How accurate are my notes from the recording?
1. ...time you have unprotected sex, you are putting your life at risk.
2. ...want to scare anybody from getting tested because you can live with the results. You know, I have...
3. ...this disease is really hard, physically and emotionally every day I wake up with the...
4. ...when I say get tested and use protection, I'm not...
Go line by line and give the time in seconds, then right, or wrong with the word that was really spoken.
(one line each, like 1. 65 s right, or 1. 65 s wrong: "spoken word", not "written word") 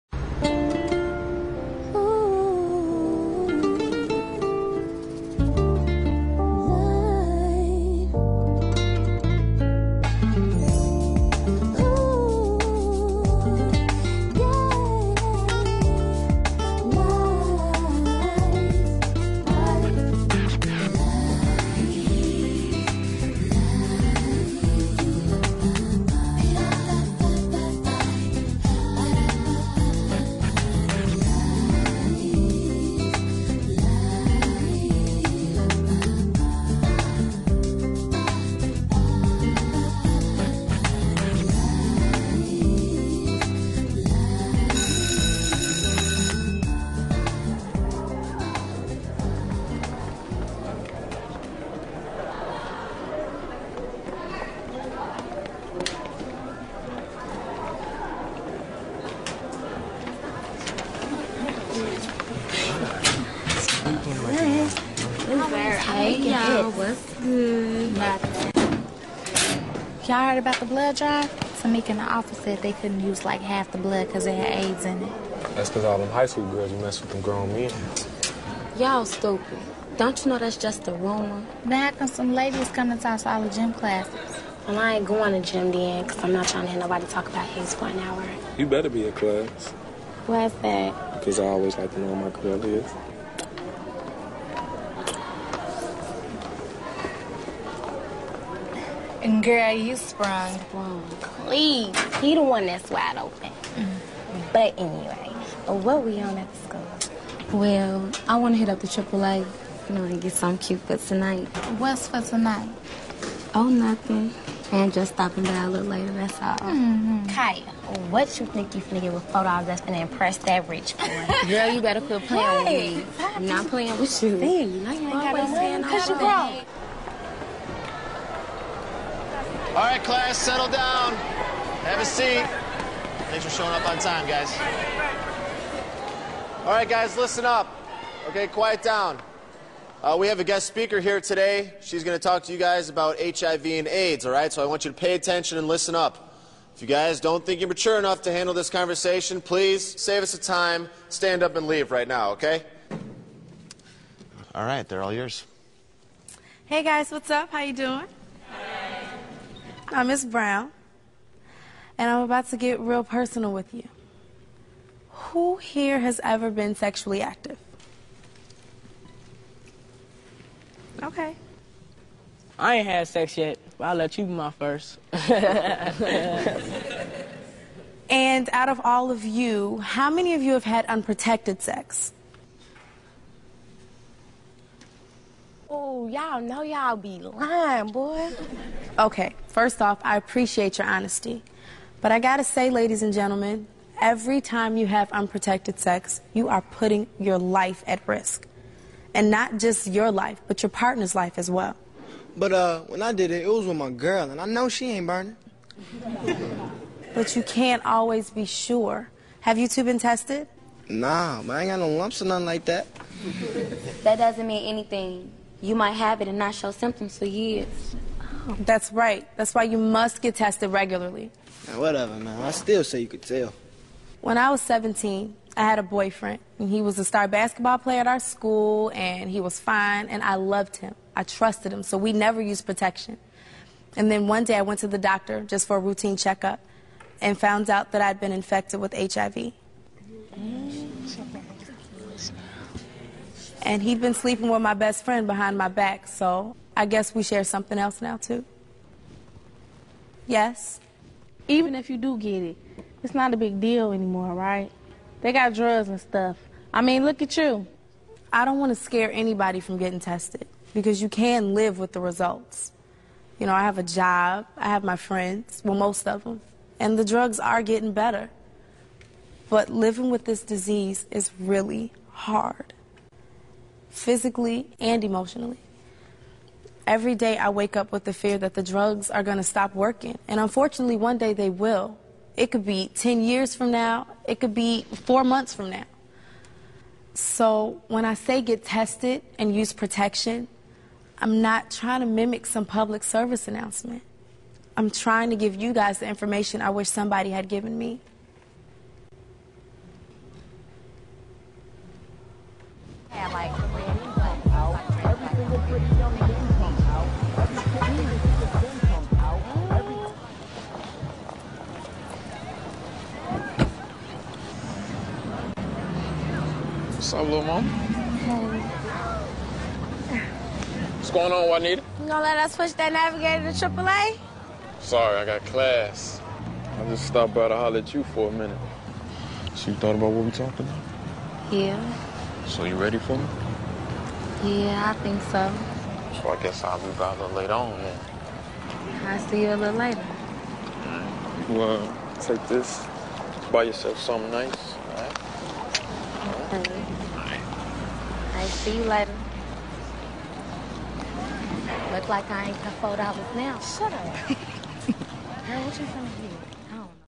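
1. 194 s right
2. 258 s right
3. 270 s right
4. 287 s right.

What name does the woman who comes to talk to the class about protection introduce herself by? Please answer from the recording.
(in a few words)
Miss Brown.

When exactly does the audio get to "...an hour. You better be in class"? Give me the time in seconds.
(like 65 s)
87 s.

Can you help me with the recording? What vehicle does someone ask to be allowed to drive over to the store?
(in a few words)
Navigator.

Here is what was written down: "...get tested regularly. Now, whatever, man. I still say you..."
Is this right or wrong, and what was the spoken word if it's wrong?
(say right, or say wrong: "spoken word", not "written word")
right.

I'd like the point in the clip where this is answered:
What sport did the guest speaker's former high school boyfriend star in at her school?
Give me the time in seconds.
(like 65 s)
227 s.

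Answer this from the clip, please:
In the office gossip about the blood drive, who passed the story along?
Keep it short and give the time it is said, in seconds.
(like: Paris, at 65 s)
Tamika, at 71 s.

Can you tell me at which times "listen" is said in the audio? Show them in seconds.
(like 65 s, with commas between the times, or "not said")
137 s, 145 s.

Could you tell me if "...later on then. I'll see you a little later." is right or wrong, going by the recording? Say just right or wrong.
right.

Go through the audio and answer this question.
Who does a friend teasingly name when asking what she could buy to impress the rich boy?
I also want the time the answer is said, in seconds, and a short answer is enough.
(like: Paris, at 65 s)
Kaya, at 117 s.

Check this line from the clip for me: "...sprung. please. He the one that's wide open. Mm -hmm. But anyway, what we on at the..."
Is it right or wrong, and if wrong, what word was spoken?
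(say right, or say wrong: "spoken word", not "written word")
right.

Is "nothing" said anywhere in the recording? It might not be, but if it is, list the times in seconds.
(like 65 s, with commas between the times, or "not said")
113 s, 212 s.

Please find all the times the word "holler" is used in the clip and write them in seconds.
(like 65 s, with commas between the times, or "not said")
327 s.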